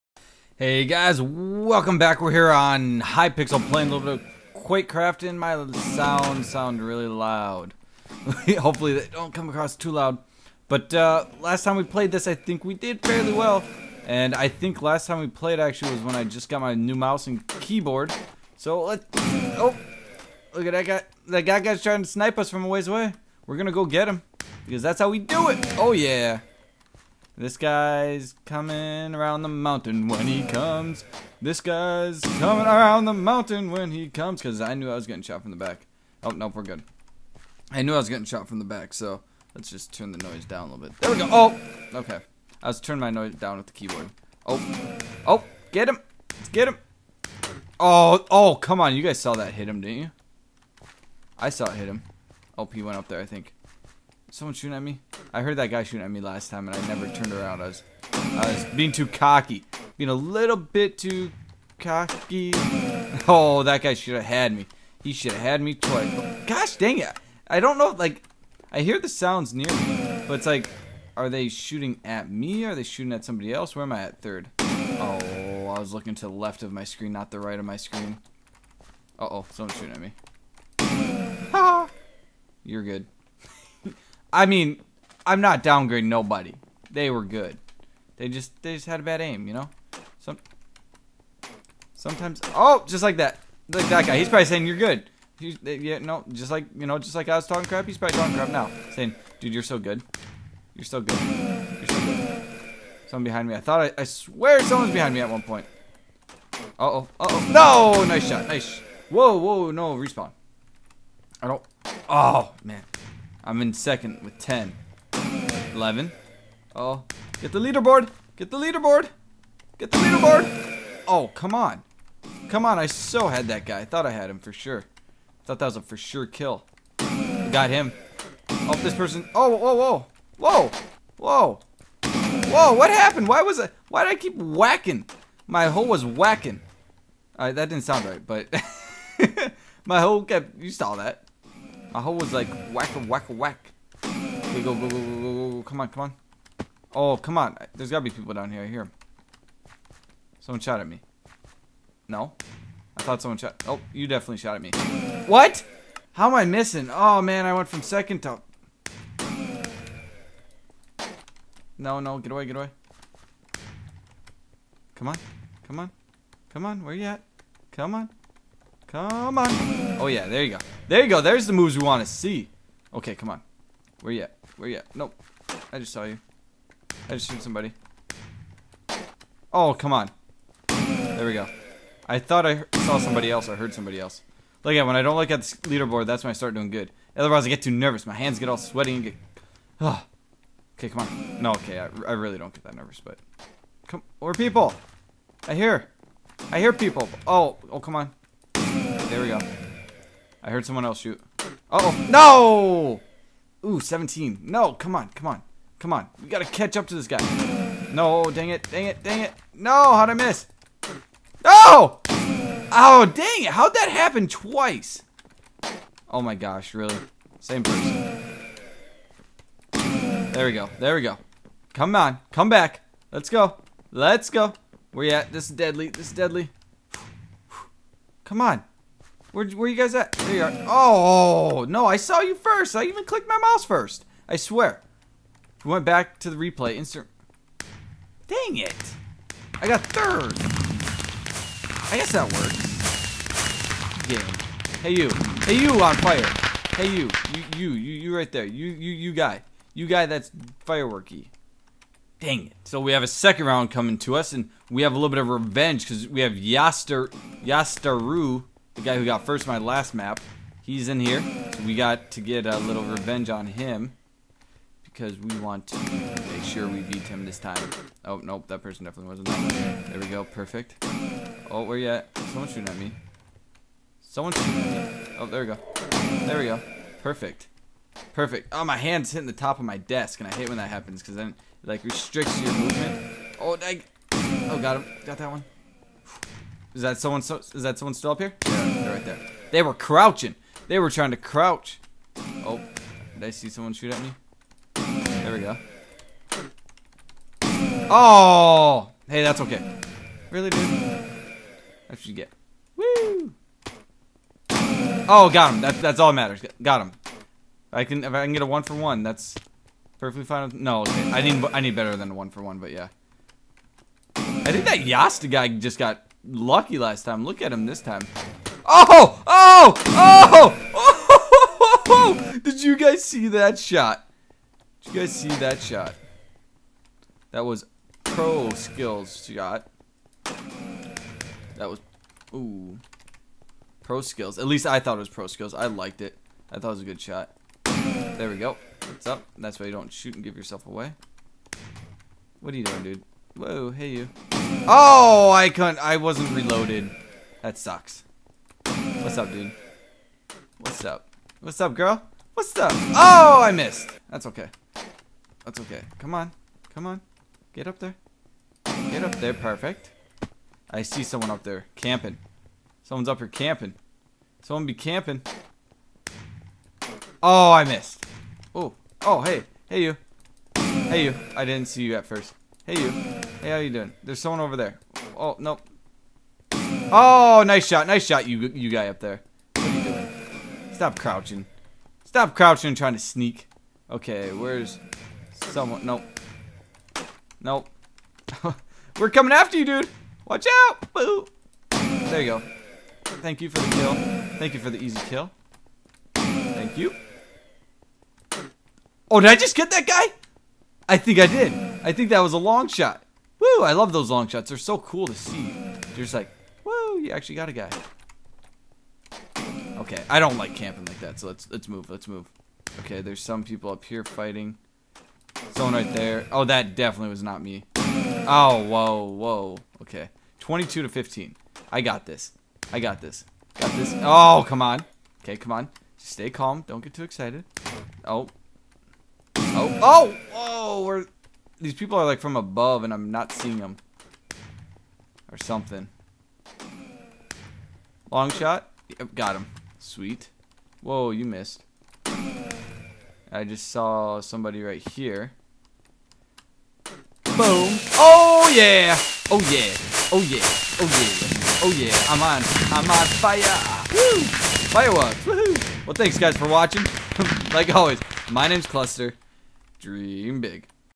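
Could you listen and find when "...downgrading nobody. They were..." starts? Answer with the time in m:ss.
1:25.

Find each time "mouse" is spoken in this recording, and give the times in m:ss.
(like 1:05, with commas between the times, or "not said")
0:16, 3:53.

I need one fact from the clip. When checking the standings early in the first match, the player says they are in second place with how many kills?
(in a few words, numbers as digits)
10.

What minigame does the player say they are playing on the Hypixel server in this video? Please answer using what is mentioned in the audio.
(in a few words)
Quakecraft.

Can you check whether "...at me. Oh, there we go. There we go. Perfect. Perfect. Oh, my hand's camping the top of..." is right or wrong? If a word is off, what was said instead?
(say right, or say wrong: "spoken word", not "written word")
wrong: "hitting", not "camping".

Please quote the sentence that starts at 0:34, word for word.
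Because I knew I was getting shot from the back.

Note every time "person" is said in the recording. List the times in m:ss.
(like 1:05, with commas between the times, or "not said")
2:08, 3:37, 4:28.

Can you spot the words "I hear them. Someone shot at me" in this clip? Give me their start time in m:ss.
2:28.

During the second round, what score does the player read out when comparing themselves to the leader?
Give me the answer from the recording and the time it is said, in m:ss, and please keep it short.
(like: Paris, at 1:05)
22 to 15, at 7:00.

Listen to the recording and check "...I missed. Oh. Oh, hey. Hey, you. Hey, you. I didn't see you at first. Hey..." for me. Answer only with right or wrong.
right.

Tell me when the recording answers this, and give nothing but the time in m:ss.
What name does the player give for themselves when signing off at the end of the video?
7:38.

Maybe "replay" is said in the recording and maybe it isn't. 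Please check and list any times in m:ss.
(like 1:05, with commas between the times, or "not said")
3:56.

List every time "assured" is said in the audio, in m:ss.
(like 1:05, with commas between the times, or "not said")
not said.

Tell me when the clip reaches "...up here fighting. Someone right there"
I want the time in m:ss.
6:53.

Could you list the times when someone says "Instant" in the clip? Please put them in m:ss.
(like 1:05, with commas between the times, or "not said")
3:56.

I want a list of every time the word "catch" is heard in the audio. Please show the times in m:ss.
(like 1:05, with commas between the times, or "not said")
3:26.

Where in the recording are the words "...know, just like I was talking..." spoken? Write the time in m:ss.
1:36.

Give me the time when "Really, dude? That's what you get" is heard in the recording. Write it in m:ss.
5:00.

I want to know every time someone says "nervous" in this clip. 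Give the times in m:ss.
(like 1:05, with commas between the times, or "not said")
3:07, 3:12.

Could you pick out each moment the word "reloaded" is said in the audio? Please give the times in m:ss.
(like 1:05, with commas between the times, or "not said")
5:46.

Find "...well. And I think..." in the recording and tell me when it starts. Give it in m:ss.
0:13.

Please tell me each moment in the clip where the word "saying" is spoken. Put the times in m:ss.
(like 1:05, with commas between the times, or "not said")
1:34, 1:38.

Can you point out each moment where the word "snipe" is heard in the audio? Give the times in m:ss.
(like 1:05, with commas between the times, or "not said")
0:22.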